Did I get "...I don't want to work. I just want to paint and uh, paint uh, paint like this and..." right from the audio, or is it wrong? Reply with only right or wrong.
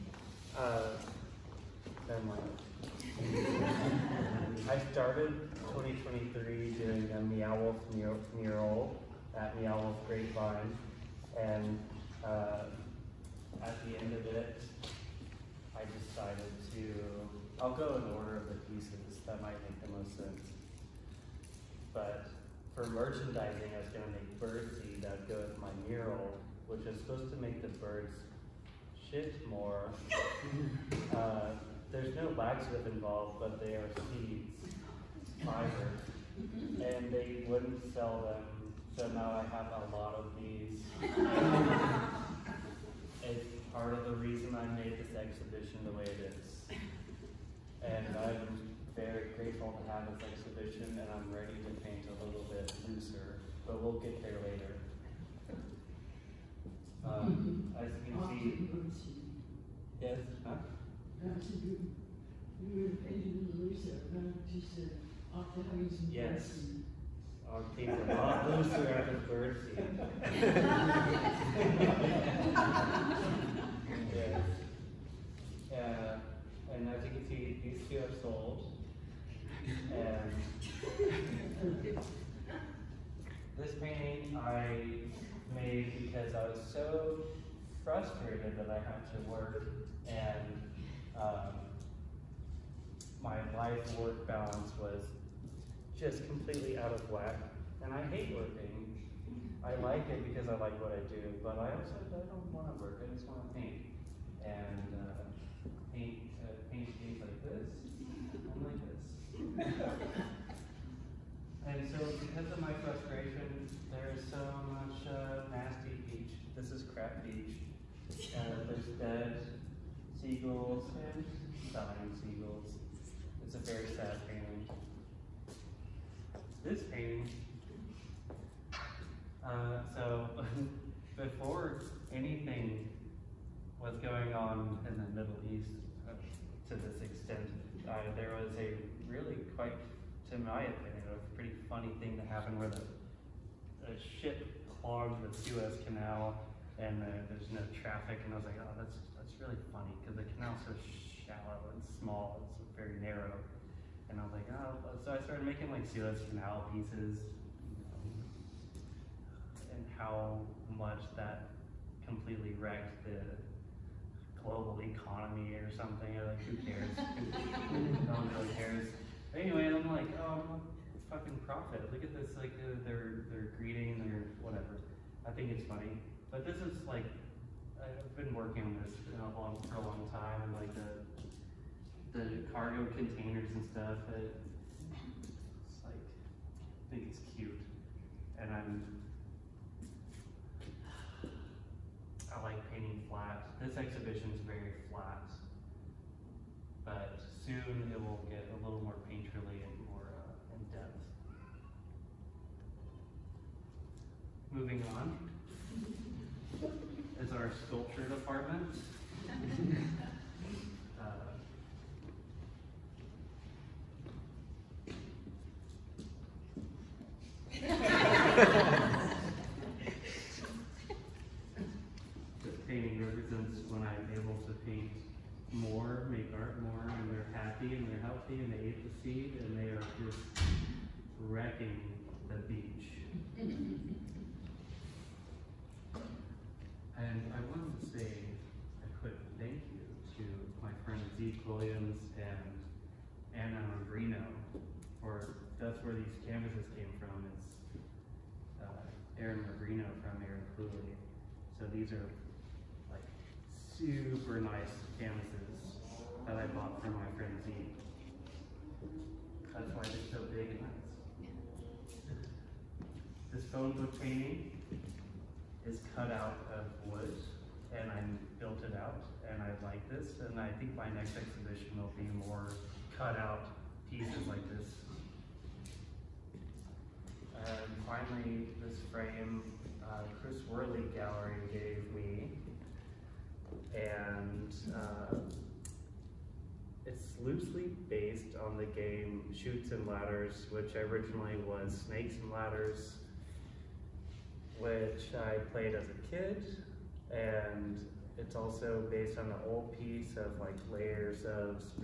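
right.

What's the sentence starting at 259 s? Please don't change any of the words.
That's why they're so big and nice.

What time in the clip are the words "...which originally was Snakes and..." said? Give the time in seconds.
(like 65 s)
290 s.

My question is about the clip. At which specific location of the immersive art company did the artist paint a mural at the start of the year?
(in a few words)
Meow Wolf Grapevine.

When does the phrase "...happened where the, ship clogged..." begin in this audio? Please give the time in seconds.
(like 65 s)
142 s.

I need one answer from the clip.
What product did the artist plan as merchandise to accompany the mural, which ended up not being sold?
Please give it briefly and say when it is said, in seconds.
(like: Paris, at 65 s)
Birdseed, at 24 s.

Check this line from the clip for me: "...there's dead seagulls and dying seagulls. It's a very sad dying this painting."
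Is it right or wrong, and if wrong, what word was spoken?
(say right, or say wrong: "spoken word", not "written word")
wrong: "feeling", not "dying".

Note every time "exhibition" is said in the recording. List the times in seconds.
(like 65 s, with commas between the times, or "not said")
45 s, 50 s, 193 s, 271 s.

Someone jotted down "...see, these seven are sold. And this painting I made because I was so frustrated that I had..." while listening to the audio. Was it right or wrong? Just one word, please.
wrong.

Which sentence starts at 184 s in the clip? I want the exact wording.
It, it's like, I think it's cute.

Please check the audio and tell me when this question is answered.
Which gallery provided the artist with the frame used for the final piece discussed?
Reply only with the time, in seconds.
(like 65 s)
280 s.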